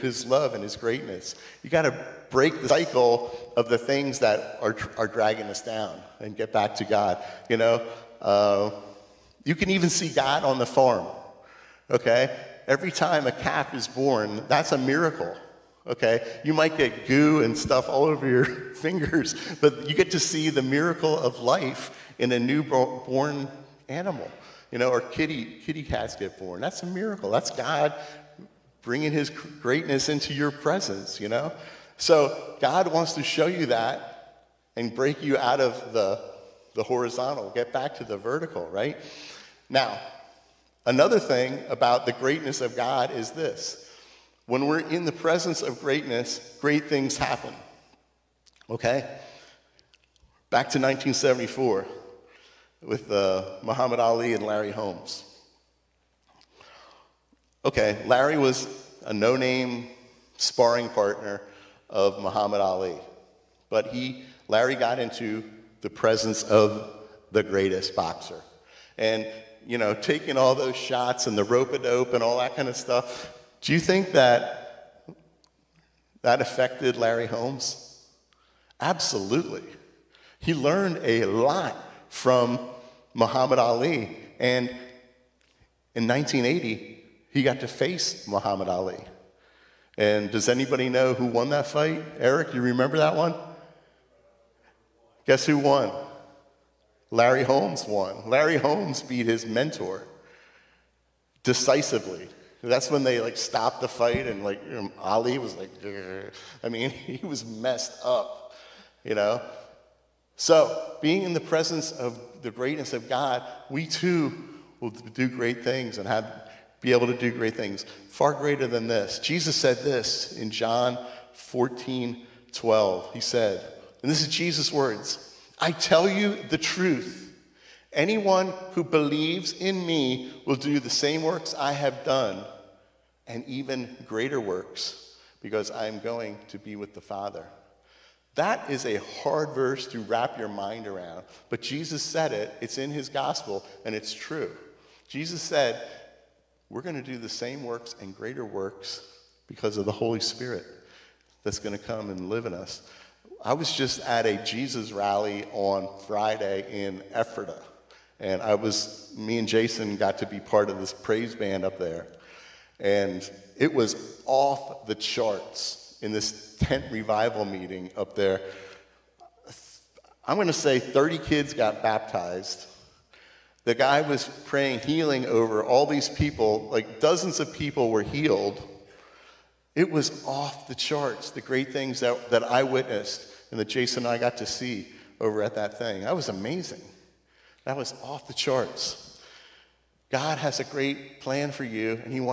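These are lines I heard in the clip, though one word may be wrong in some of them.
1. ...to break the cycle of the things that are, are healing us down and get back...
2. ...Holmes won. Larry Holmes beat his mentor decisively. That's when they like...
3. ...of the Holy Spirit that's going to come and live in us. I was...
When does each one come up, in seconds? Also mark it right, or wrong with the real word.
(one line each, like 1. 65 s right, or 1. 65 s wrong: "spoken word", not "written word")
1. 1 s wrong: "dragging", not "healing"
2. 97 s right
3. 149 s right.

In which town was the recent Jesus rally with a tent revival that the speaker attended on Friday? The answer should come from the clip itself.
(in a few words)
Ephrata.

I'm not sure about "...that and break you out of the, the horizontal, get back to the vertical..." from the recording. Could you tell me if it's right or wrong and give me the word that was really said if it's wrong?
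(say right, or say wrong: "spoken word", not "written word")
right.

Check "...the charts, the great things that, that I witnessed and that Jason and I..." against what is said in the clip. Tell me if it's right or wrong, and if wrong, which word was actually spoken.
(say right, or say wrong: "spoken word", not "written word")
right.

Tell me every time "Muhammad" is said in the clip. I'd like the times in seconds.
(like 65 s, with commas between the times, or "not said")
53 s, 62 s, 83 s, 88 s.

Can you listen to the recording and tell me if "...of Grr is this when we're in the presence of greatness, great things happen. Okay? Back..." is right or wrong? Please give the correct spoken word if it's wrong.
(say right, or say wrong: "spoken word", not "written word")
wrong: "God", not "Grr".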